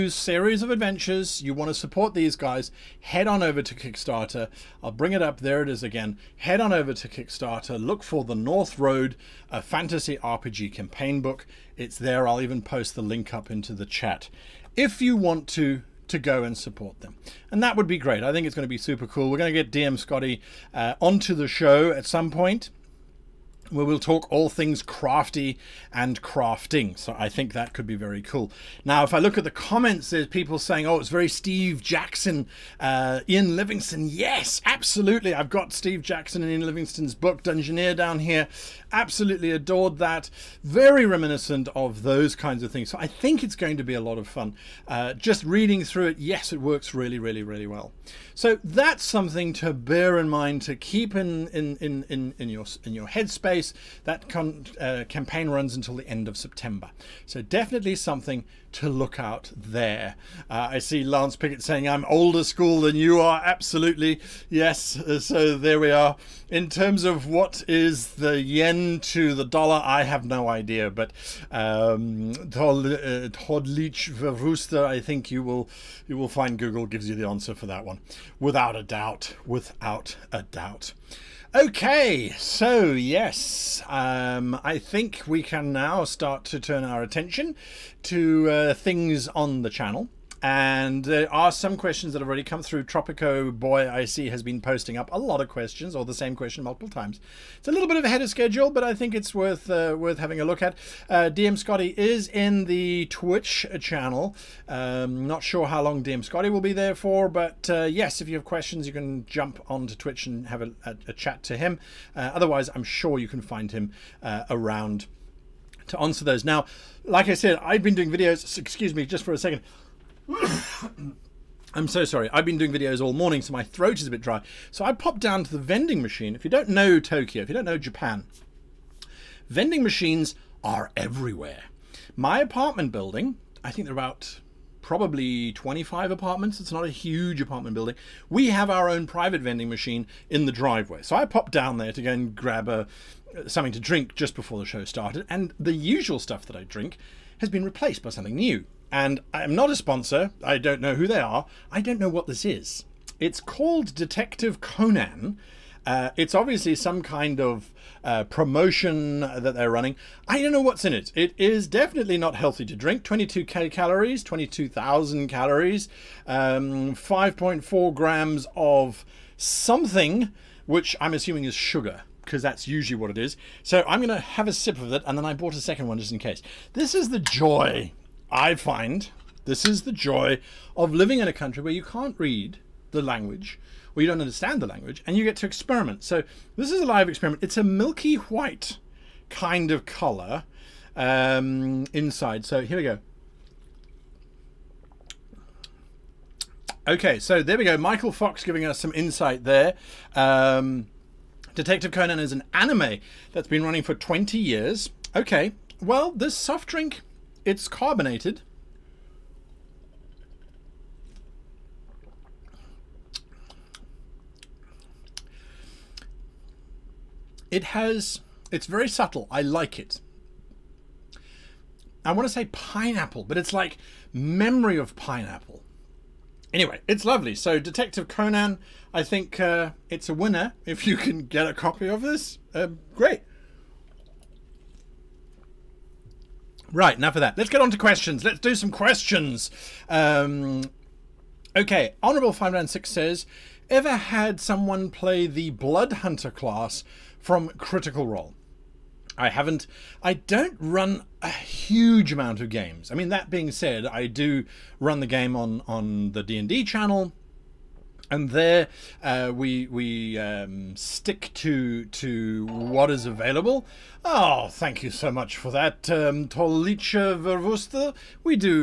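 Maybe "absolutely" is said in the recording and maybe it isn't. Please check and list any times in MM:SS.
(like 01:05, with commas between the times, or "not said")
00:34, 00:38, 01:03.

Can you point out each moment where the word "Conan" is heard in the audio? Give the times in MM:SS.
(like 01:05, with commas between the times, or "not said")
02:34, 03:21, 03:48.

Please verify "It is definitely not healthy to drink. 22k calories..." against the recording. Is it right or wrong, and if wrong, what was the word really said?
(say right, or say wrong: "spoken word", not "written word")
right.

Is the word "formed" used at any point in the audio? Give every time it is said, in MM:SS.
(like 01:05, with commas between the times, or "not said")
not said.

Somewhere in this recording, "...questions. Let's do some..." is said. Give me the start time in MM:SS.
03:57.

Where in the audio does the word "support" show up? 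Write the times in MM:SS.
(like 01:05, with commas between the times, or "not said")
00:01, 00:16.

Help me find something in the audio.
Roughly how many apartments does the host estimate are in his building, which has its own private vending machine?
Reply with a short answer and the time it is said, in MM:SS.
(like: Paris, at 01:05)
25, at 02:15.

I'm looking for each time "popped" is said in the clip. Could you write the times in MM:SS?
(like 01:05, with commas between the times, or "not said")
02:04, 02:21.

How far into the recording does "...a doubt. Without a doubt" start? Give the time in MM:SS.
01:18.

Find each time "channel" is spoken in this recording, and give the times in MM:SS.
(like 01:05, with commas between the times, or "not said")
01:29, 01:43, 04:16.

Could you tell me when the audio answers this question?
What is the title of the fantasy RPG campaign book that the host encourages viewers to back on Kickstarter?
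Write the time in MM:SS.
00:08.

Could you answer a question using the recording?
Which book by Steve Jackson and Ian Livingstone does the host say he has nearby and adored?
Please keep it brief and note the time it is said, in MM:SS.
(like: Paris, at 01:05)
Dungeoneer, at 00:37.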